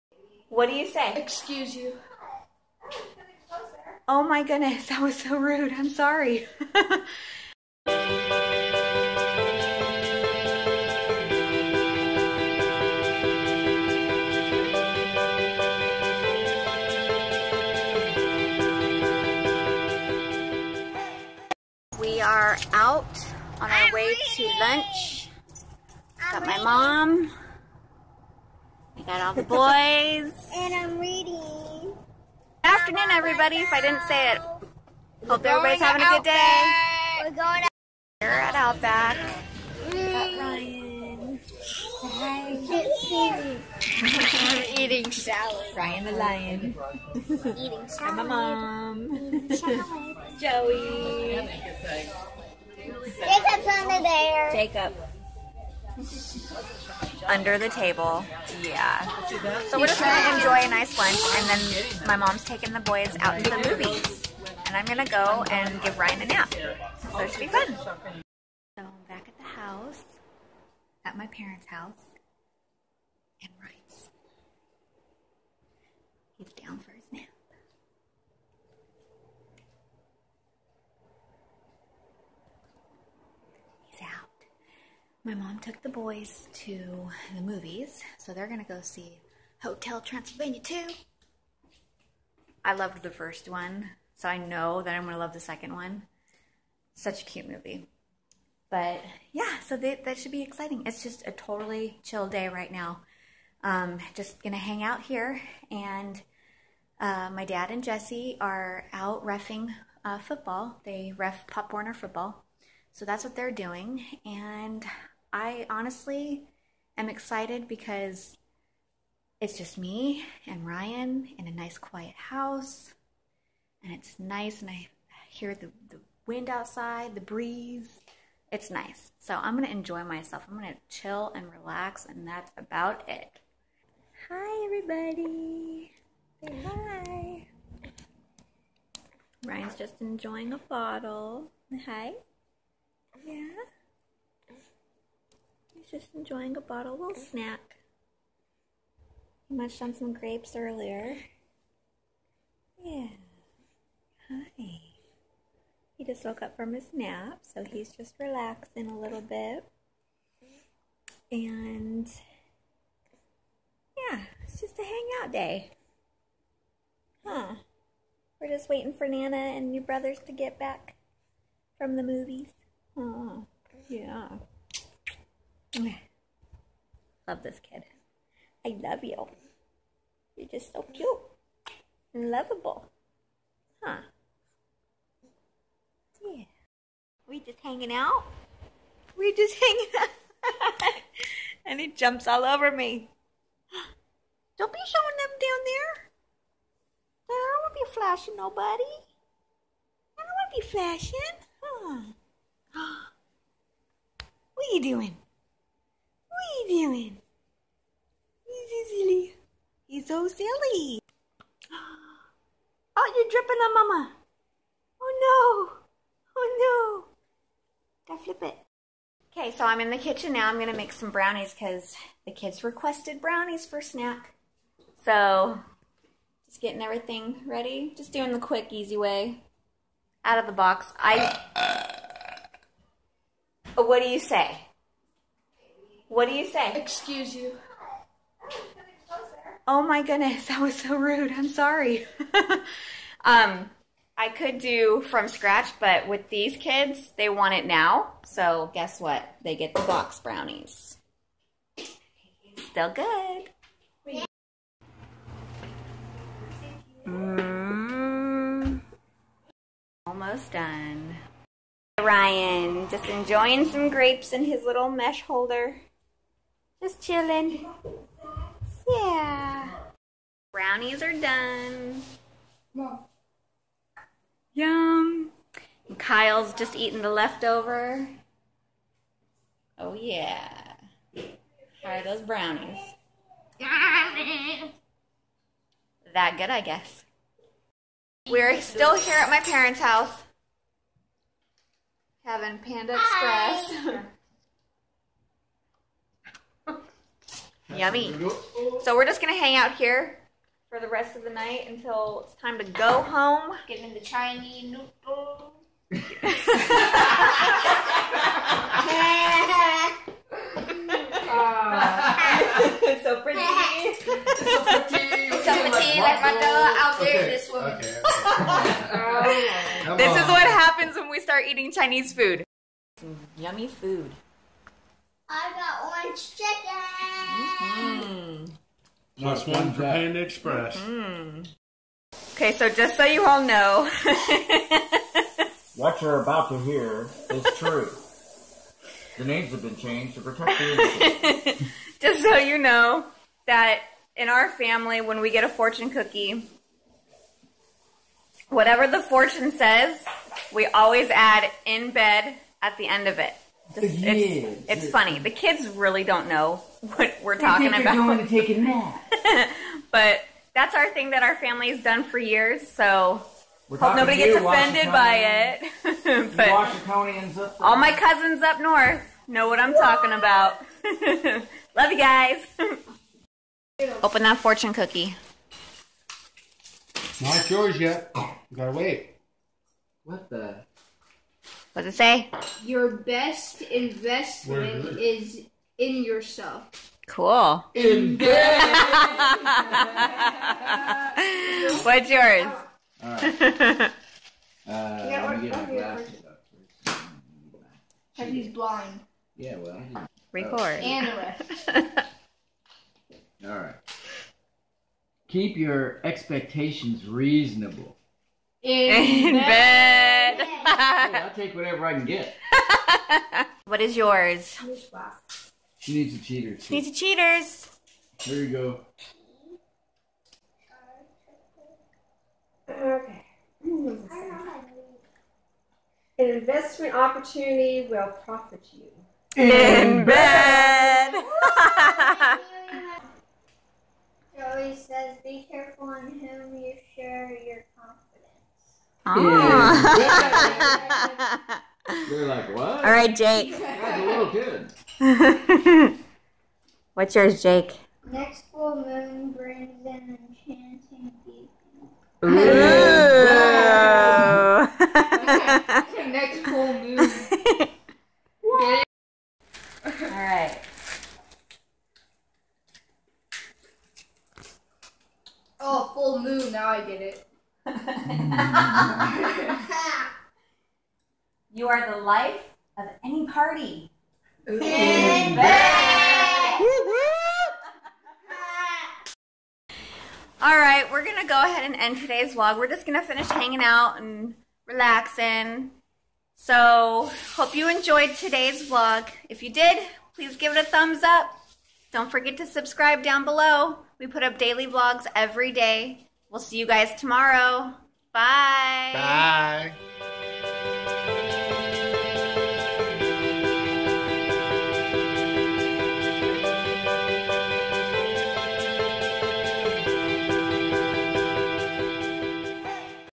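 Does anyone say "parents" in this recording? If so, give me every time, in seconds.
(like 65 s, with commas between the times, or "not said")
71 s, 289 s.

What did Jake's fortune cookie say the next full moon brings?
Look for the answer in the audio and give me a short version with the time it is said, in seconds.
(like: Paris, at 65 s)
an enchanting beacon, at 449 s.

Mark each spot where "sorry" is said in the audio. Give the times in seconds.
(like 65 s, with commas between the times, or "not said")
5 s, 241 s.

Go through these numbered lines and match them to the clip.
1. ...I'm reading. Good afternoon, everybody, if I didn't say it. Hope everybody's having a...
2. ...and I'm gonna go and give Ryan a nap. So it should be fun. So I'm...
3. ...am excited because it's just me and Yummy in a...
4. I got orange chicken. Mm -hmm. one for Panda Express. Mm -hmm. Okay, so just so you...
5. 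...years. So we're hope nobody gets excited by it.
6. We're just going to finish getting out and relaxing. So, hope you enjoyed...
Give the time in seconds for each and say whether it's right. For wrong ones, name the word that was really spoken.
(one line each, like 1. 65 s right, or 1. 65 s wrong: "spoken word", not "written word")
1. 30 s right
2. 64 s right
3. 116 s wrong: "Ryan", not "Yummy"
4. 325 s right
5. 362 s wrong: "offended", not "excited"
6. 482 s wrong: "hanging", not "getting".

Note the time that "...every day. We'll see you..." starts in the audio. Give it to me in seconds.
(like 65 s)
495 s.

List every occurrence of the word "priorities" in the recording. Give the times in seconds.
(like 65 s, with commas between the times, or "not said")
not said.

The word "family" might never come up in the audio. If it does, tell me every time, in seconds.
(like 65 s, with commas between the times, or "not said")
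344 s, 361 s.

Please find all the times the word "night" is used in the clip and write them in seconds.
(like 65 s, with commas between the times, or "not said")
301 s.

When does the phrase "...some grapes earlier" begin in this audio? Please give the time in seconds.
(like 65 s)
149 s.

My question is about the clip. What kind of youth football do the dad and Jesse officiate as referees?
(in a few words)
Pop Warner.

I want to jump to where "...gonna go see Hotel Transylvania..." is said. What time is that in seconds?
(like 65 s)
88 s.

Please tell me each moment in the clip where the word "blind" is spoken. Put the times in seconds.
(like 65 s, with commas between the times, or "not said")
398 s.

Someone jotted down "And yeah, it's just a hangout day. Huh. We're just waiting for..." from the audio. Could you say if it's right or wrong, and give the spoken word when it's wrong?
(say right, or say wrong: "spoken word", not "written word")
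right.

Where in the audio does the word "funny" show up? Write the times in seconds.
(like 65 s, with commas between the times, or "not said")
354 s.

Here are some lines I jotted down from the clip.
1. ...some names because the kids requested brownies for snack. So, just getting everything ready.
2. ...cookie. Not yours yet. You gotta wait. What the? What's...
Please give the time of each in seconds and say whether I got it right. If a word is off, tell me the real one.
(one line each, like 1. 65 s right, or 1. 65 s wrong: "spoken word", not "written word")
1. 220 s wrong: "brownies", not "names"
2. 374 s right.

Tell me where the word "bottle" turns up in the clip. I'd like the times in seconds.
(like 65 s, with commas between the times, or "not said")
140 s, 146 s.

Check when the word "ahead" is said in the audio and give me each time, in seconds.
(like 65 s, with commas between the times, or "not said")
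481 s.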